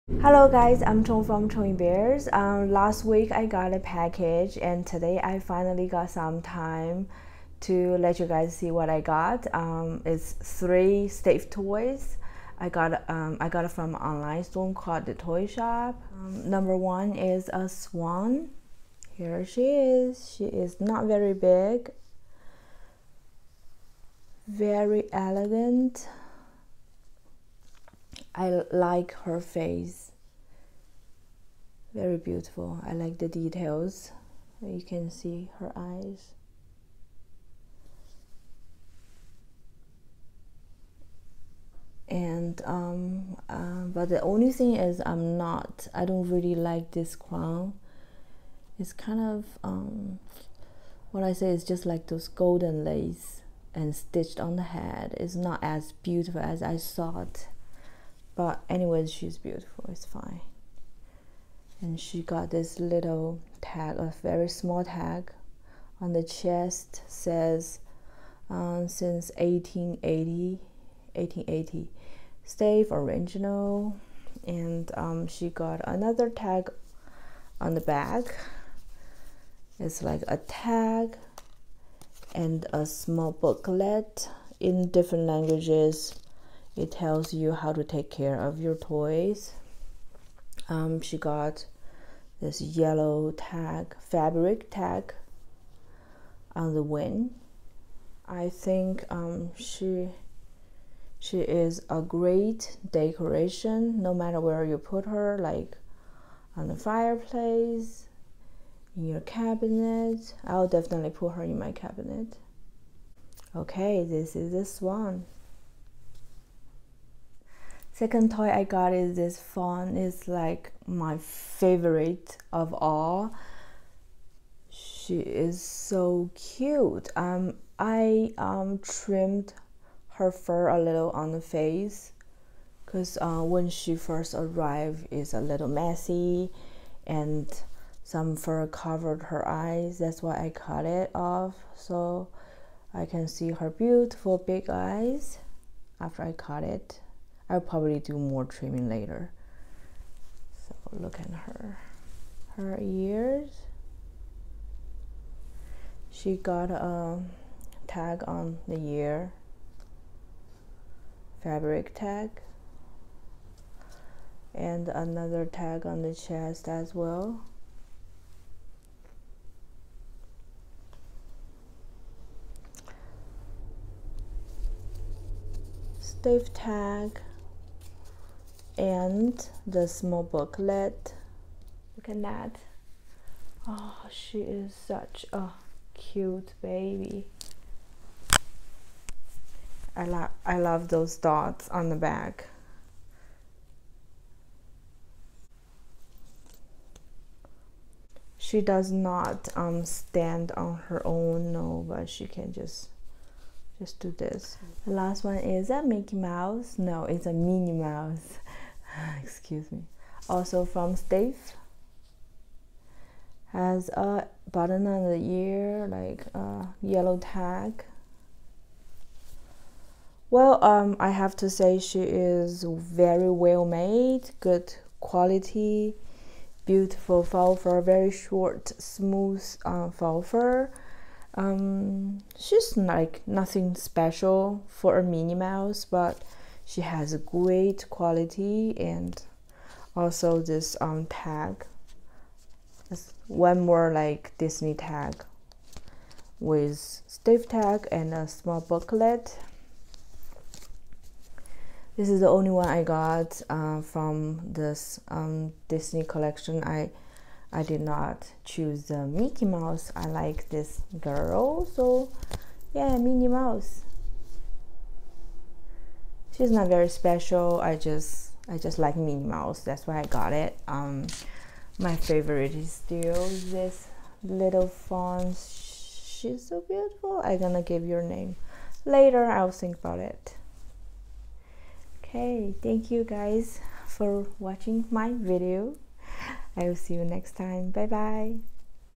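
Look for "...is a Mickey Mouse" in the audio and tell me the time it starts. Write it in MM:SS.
03:25.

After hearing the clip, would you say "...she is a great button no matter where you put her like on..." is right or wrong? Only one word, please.
wrong.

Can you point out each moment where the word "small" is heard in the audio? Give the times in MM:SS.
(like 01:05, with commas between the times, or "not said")
01:04, 01:22, 02:59, 04:08.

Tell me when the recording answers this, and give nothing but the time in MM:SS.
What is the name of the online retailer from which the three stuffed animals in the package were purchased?
00:15.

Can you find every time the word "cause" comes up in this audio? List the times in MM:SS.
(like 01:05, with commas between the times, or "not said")
02:12.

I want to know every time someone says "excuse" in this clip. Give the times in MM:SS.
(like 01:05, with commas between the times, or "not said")
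03:29.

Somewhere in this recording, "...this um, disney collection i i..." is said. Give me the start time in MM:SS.
04:14.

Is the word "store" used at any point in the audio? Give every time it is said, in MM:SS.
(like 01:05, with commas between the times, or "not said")
00:14.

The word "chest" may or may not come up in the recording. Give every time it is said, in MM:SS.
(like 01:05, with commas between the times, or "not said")
01:06, 02:46.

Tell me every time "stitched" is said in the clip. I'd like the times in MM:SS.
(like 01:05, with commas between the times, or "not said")
00:53.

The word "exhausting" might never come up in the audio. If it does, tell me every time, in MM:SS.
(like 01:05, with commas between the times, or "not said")
not said.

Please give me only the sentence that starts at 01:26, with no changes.
It tells you how to take care of your toys.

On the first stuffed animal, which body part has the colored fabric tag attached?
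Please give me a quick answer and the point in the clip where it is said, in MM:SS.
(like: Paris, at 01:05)
the wing, at 01:36.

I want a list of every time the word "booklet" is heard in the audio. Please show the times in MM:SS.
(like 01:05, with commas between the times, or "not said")
01:23, 03:00, 04:08.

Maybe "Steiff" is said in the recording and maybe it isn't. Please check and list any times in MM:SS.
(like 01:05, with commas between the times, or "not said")
00:11, 01:12, 02:55, 03:30, 04:07.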